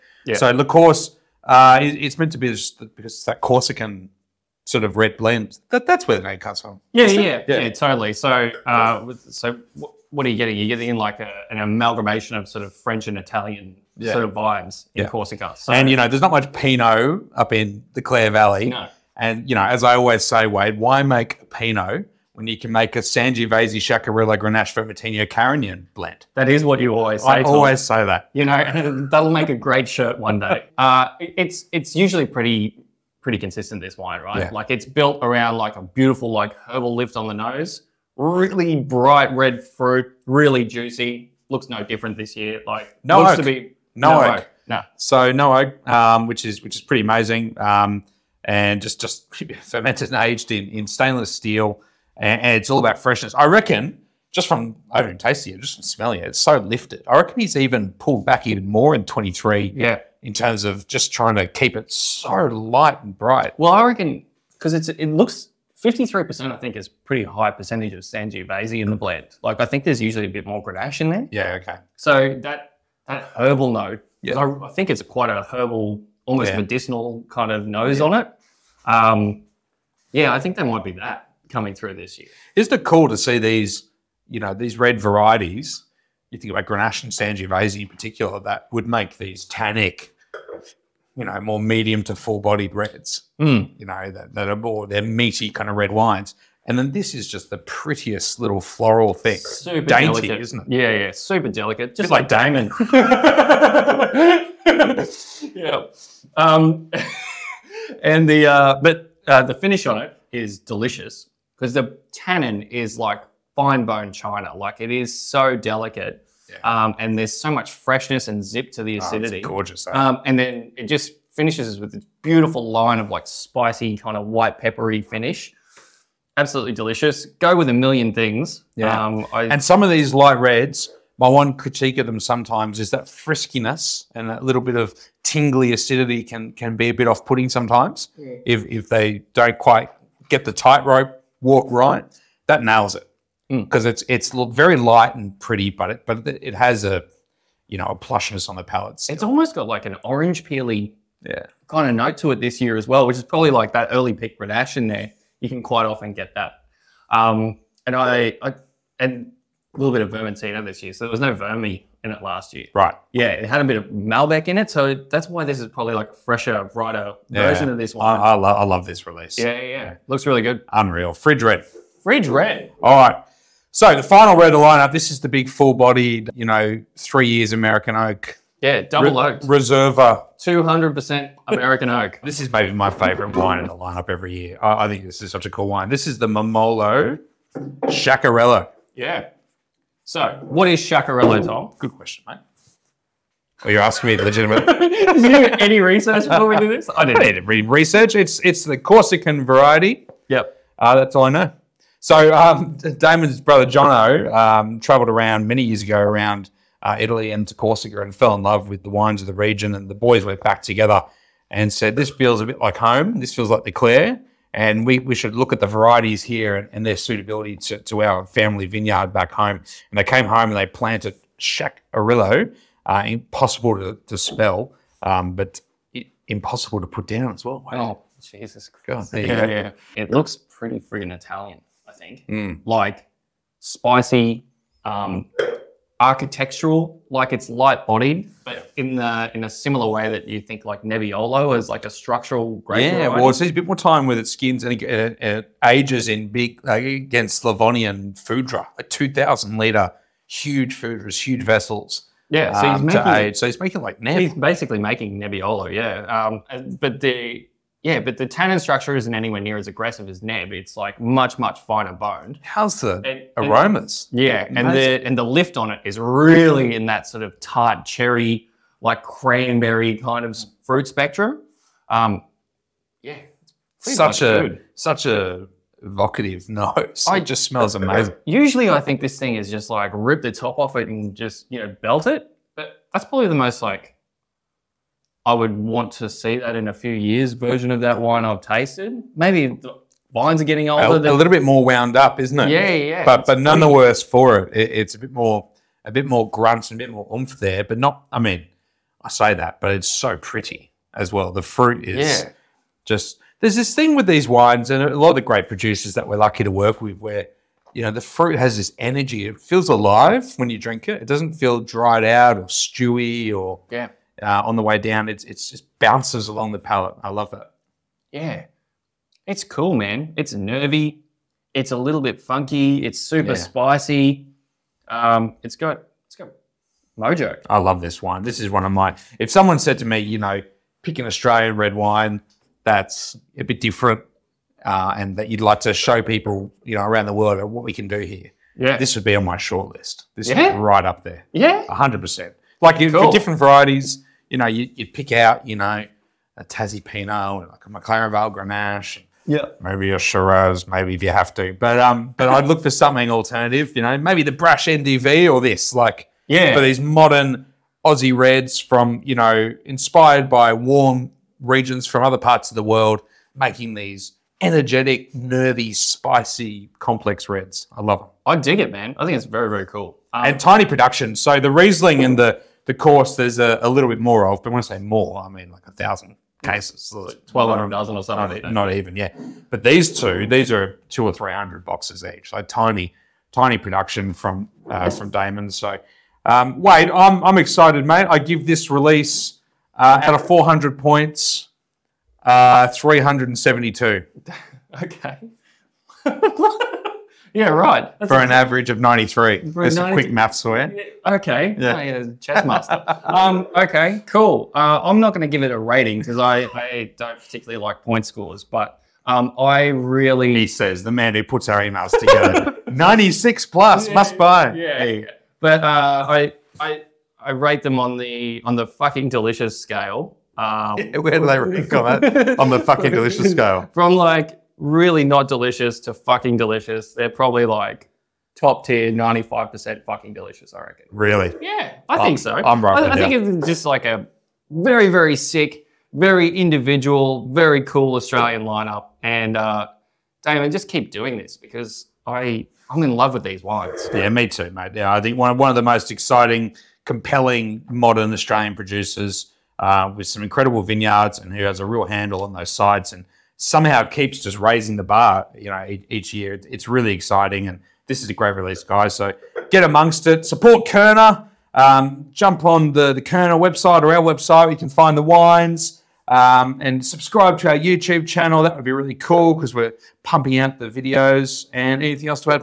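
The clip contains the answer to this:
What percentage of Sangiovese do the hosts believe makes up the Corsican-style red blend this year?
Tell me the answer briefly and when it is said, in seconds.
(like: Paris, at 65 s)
53%, at 65 s.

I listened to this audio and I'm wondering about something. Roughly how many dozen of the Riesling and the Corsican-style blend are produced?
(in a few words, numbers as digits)
1,200 dozen.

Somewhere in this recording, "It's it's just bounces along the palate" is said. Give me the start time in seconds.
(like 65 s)
315 s.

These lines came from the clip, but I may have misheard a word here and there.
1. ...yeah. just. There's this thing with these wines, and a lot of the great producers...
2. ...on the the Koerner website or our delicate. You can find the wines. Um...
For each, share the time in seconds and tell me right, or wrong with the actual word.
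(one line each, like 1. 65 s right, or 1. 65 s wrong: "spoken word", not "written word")
1. 302 s right
2. 462 s wrong: "website", not "delicate".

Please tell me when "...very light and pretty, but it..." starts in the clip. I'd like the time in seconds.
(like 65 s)
144 s.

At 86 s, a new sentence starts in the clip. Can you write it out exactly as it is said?
You think about Grenache and Sangiovese in particular, that would make these tannic, you know, more medium to full bodied reds, mm.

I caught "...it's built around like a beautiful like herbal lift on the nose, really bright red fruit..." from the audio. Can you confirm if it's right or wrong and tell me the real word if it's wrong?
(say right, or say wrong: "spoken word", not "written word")
right.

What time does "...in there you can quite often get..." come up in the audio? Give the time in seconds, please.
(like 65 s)
154 s.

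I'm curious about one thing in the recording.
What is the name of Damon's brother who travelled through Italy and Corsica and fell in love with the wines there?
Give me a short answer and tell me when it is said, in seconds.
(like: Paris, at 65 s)
Jono, at 203 s.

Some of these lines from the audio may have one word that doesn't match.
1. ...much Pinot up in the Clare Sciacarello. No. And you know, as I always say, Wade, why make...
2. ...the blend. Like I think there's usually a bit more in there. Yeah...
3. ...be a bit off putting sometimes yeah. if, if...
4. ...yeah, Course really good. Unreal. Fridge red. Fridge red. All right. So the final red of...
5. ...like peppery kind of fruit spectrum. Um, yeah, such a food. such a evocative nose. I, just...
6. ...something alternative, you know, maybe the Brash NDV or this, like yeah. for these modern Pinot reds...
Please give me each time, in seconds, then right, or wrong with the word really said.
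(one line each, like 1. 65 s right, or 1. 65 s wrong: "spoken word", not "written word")
1. 16 s wrong: "Valley", not "Sciacarello"
2. 68 s right
3. 136 s right
4. 169 s wrong: "Looks", not "Course"
5. 268 s wrong: "cranberry", not "peppery"
6. 352 s wrong: "Aussie", not "Pinot".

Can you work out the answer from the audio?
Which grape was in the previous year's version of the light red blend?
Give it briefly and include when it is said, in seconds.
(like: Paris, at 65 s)
Malbec, at 163 s.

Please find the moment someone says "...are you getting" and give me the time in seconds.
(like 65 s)
10 s.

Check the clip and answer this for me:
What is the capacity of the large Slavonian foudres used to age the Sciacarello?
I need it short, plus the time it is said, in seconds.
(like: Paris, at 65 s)
2,000 liters, at 248 s.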